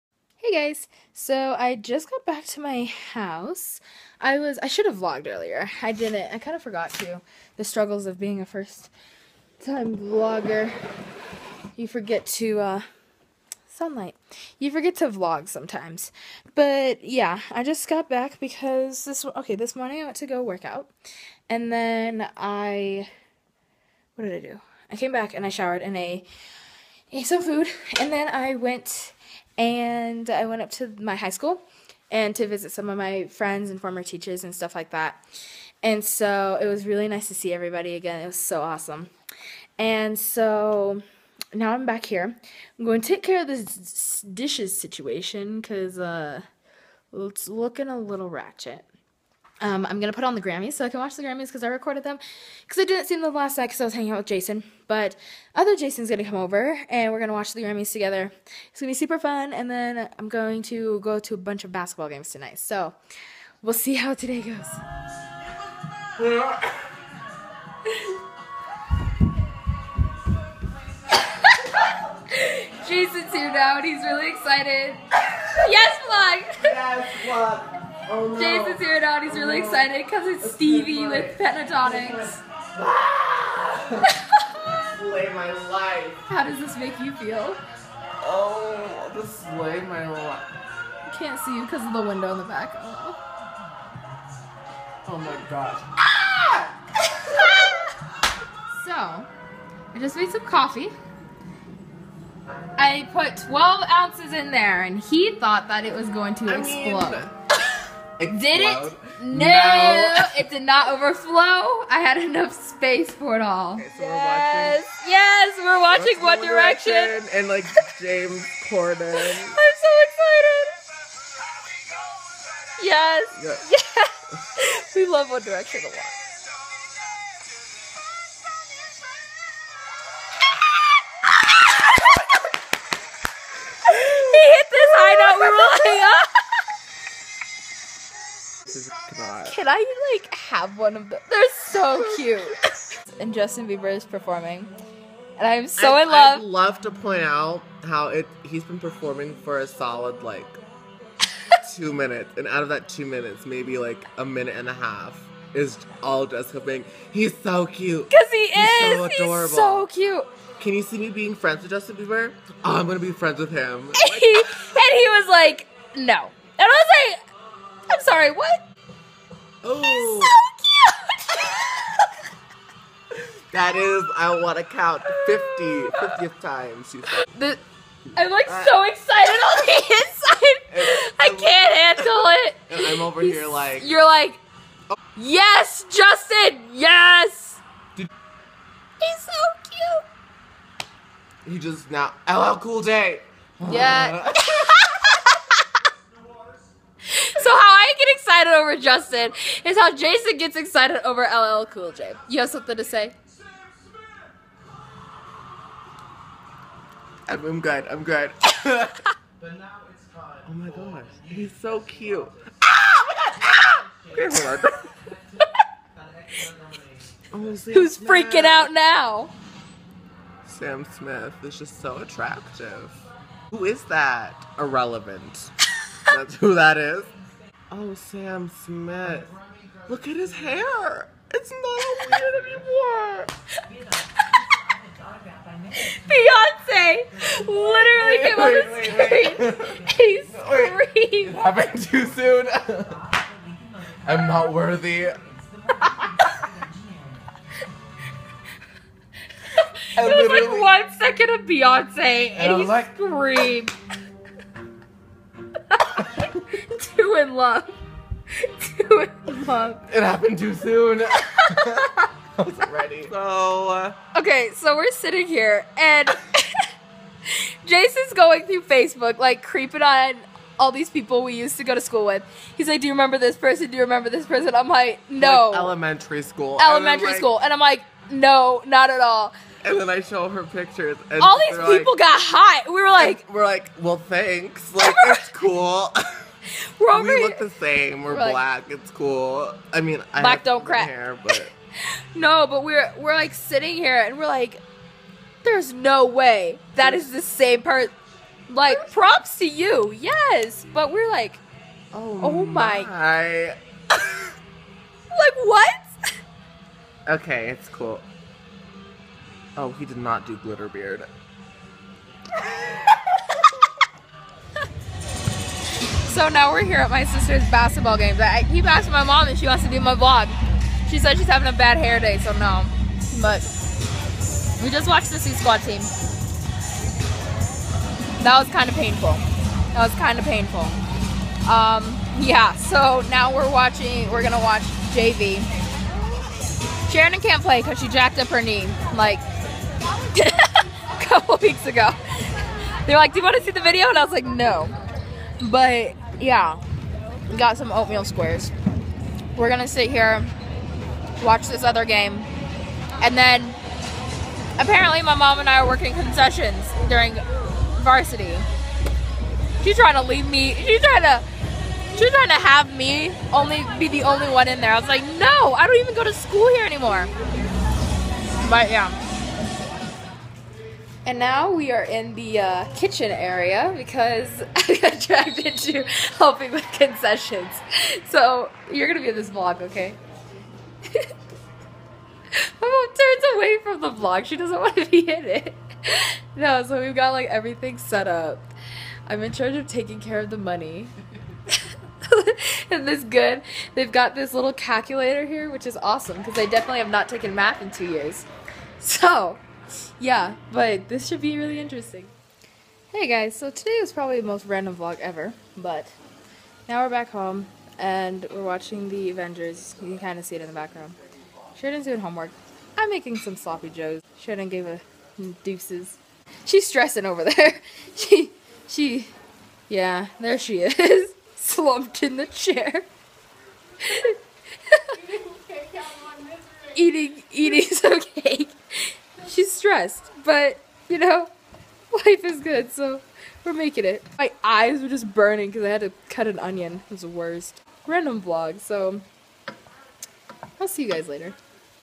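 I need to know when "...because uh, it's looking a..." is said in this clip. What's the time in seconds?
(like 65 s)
45 s.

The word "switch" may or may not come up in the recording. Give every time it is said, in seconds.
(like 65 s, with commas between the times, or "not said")
not said.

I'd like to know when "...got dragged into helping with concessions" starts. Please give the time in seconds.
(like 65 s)
374 s.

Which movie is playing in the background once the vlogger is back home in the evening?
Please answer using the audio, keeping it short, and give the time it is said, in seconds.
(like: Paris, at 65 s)
The Avengers, at 408 s.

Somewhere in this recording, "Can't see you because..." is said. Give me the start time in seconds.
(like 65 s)
91 s.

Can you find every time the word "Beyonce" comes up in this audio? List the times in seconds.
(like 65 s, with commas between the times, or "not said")
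236 s, 251 s.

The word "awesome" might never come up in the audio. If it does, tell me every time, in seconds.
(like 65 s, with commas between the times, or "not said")
38 s, 395 s.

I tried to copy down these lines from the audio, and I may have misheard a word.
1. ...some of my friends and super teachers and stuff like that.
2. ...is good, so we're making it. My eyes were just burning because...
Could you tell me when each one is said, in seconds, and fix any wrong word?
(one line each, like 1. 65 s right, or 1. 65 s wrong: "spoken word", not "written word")
1. 32 s wrong: "former", not "super"
2. 432 s right.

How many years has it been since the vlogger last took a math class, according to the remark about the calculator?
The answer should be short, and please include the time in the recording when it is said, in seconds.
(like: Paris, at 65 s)
2, at 397 s.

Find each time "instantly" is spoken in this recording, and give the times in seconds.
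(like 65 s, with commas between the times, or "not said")
not said.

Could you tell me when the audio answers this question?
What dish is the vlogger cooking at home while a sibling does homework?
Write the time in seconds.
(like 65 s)
413 s.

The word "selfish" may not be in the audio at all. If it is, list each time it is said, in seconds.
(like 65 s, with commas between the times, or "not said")
not said.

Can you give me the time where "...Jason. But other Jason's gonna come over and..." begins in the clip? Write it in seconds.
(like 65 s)
54 s.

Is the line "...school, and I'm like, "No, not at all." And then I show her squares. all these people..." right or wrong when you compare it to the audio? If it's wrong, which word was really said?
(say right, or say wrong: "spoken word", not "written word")
wrong: "pictures", not "squares".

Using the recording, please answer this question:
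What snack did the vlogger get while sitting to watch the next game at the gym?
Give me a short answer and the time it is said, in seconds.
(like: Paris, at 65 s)
Oatmeal squares, at 347 s.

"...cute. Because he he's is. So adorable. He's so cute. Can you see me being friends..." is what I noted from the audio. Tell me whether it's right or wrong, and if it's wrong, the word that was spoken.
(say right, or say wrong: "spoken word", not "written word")
right.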